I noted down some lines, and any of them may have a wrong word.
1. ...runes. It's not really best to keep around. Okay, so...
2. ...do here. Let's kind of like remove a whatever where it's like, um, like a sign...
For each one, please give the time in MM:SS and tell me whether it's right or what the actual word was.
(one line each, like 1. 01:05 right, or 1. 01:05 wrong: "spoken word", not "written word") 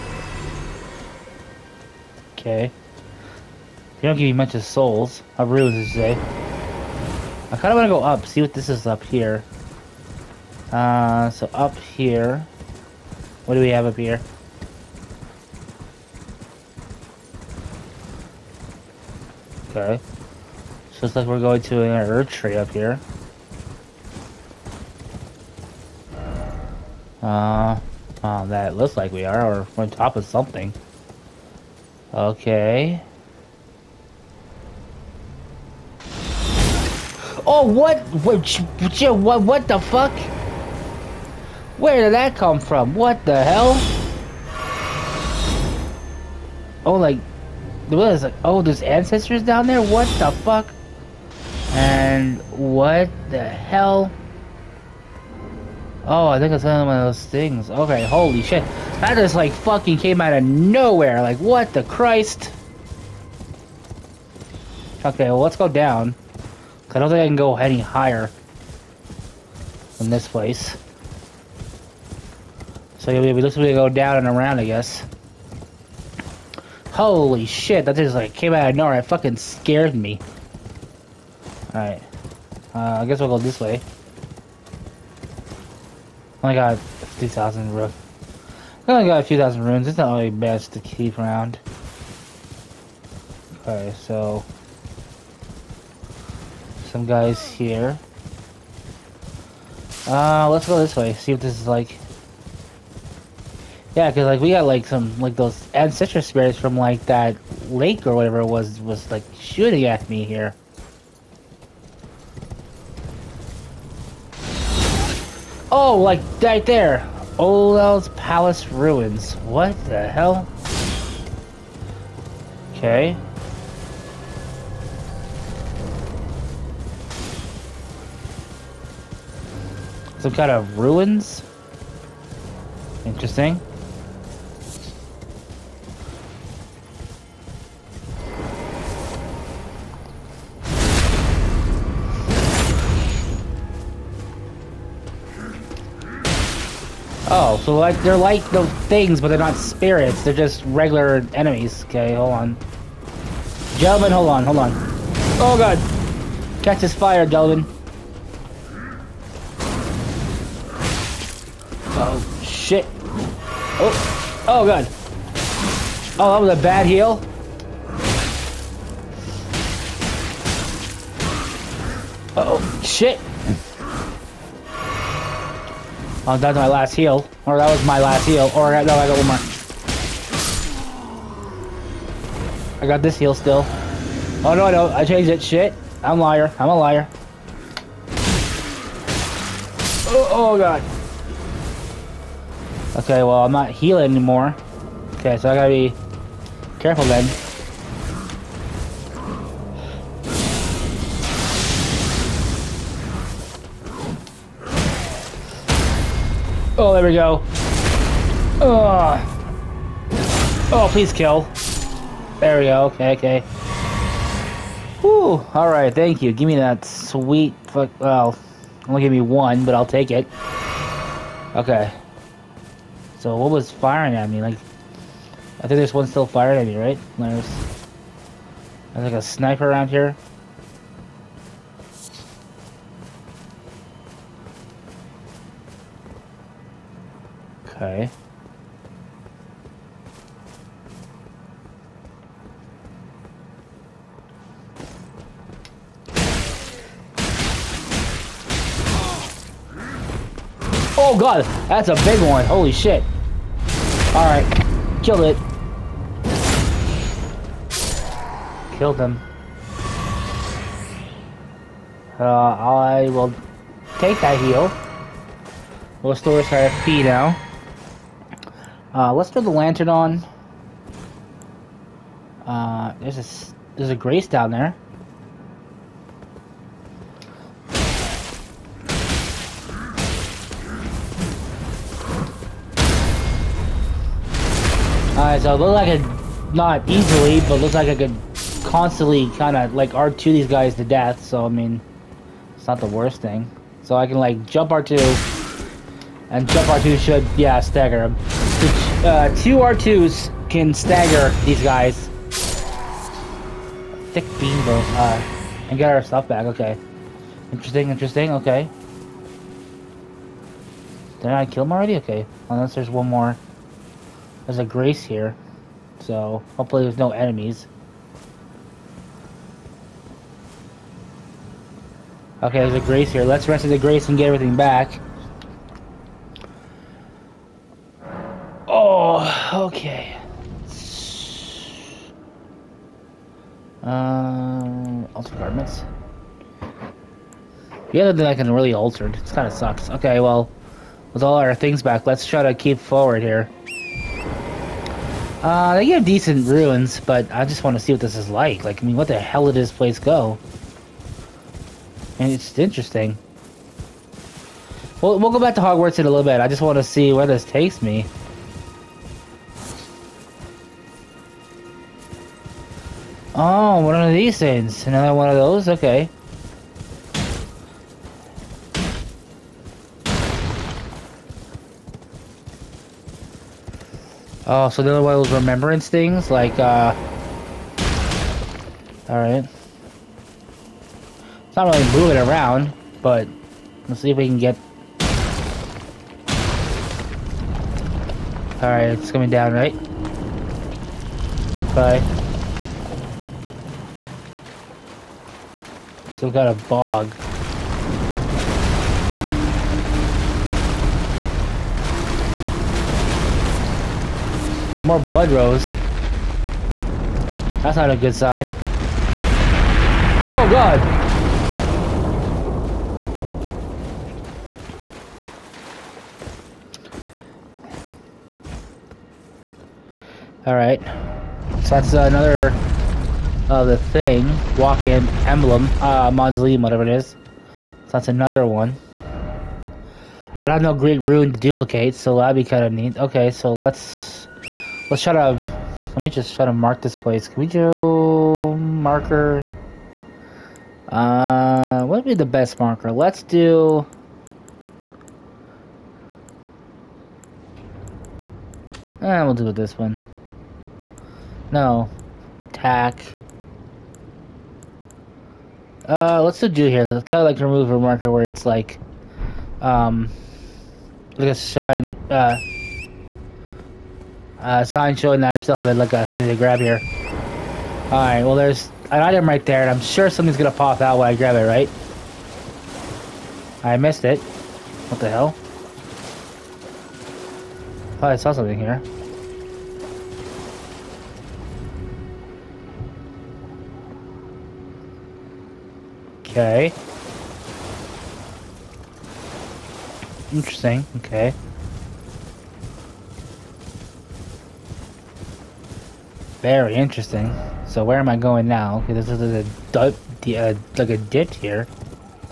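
1. 01:29 right
2. 07:36 wrong: "marker", not "whatever".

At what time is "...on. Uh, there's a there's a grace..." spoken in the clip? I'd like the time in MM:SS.
04:29.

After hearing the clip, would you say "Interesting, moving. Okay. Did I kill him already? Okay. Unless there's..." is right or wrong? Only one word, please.
wrong.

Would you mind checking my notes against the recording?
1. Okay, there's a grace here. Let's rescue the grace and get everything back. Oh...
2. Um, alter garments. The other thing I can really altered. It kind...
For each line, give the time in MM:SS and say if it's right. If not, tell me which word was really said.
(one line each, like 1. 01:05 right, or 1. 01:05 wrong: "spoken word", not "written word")
1. 05:22 right
2. 05:33 right.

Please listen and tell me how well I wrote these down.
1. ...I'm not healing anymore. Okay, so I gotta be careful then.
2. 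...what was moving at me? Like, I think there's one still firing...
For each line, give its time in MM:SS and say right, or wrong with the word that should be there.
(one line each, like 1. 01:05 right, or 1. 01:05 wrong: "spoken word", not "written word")
1. 03:13 right
2. 03:43 wrong: "firing", not "moving".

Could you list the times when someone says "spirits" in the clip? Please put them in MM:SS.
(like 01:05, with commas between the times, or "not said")
01:46, 02:29.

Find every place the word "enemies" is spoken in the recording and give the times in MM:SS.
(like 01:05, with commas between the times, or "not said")
02:31, 05:17.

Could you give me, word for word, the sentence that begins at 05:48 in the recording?
Like, I mean, what the hell did this place go?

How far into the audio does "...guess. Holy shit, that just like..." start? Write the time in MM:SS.
01:14.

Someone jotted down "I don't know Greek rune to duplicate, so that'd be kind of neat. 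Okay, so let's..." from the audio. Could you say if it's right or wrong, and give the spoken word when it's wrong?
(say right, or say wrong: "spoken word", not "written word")
right.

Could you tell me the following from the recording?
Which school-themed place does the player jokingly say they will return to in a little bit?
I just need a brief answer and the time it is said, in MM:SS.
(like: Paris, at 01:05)
Hogwarts, at 05:55.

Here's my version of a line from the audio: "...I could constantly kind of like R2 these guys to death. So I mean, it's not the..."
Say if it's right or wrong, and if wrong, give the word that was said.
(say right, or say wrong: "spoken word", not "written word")
right.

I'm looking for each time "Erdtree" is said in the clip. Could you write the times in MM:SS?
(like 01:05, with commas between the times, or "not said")
00:22.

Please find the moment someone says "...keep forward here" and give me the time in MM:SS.
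05:42.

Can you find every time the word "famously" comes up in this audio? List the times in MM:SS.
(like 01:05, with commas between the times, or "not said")
not said.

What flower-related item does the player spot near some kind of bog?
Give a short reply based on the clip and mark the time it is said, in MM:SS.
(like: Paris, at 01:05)
Blood rose, at 06:44.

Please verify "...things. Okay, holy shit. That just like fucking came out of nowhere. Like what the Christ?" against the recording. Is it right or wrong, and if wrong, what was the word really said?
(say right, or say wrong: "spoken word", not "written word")
right.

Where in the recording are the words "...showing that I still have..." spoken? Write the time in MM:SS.
07:44.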